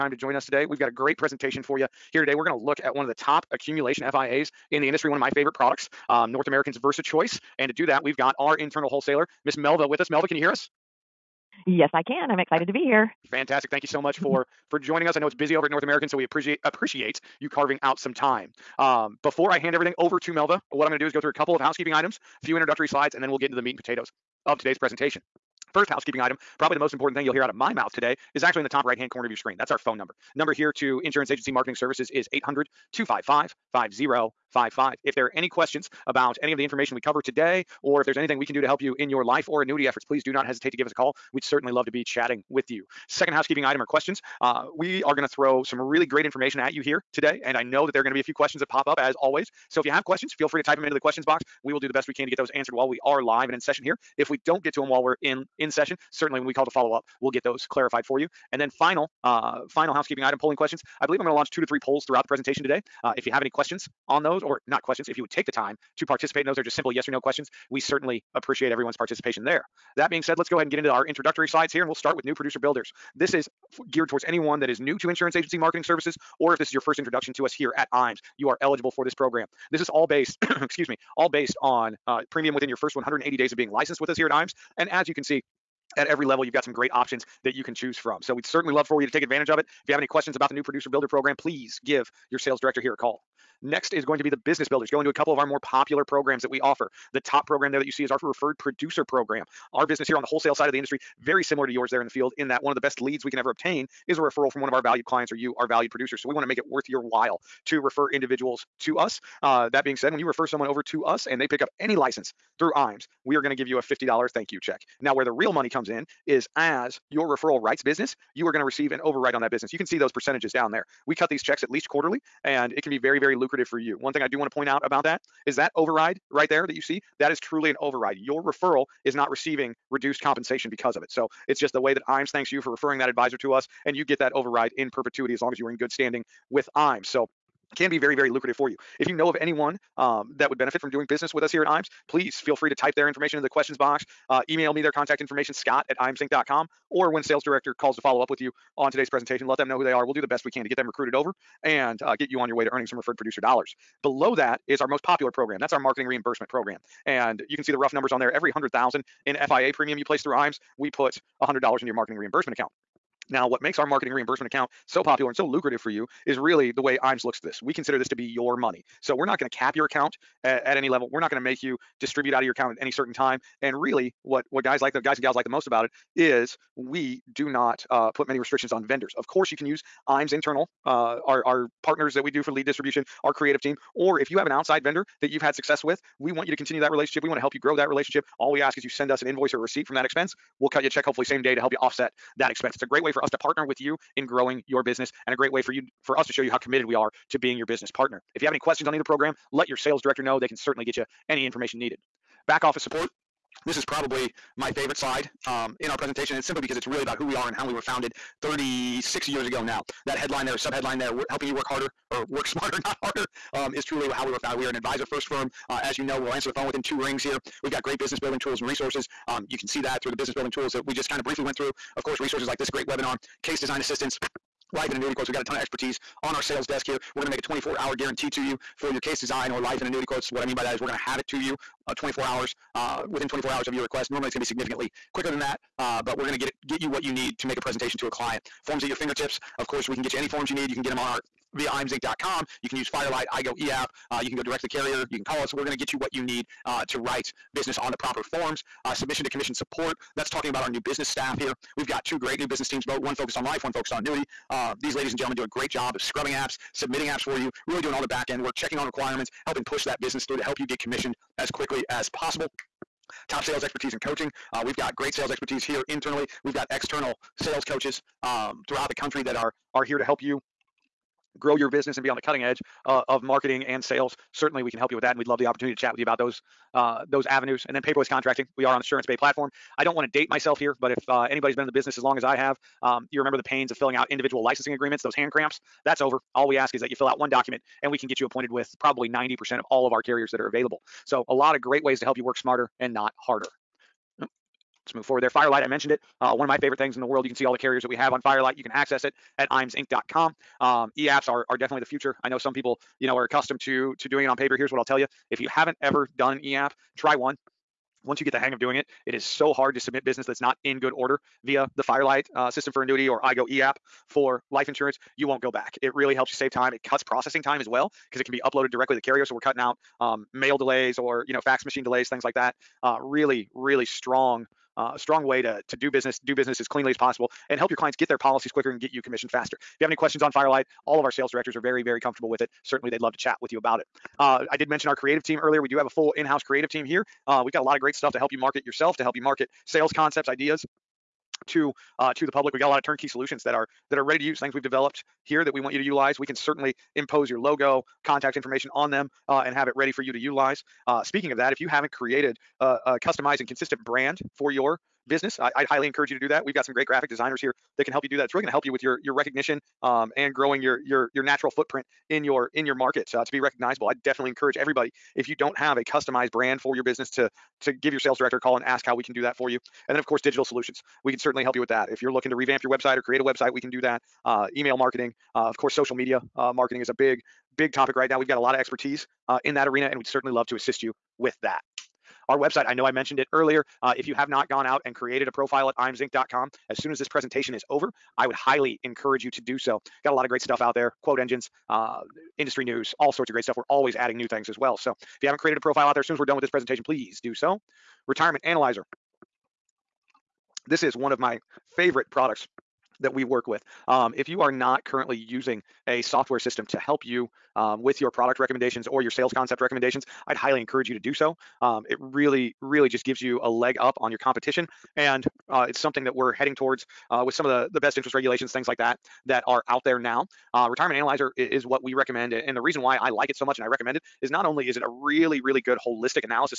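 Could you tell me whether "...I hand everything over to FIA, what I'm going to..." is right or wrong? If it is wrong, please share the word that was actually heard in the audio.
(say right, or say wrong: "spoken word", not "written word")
wrong: "Melva", not "FIA".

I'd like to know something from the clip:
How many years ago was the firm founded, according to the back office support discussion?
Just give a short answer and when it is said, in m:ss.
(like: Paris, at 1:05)
36, at 3:28.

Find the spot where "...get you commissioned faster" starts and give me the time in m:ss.
5:28.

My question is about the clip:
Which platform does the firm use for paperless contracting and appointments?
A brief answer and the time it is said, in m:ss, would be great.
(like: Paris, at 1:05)
Assurance Bay, at 4:38.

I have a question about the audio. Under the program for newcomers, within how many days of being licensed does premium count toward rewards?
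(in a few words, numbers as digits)
180.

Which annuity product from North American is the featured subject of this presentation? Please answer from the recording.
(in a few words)
VersaChoice.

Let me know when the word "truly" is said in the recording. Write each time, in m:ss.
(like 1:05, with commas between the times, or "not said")
2:07, 3:33.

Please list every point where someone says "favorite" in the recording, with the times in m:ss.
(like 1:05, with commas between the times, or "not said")
0:05, 3:24, 4:56, 6:41.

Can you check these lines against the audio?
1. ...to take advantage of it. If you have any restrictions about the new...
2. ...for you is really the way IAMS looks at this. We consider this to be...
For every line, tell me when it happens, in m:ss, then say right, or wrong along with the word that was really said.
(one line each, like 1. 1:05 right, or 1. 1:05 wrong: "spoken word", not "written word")
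1. 1:29 wrong: "questions", not "restrictions"
2. 2:45 right.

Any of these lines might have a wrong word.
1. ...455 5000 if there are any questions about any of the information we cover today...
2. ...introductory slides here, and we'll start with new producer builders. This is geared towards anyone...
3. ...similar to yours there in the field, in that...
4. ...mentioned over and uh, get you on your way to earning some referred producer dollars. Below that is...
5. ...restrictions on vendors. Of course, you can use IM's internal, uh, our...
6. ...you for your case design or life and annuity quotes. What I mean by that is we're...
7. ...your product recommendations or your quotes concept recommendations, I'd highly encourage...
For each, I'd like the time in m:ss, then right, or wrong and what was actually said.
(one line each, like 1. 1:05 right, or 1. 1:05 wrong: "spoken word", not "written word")
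1. 0:32 wrong: "255", not "455"
2. 1:11 right
3. 1:41 right
4. 2:30 wrong: "recruited", not "mentioned"
5. 2:58 right
6. 3:48 right
7. 6:47 wrong: "sales", not "quotes".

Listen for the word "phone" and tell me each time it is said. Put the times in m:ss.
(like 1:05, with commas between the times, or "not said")
0:29, 3:36.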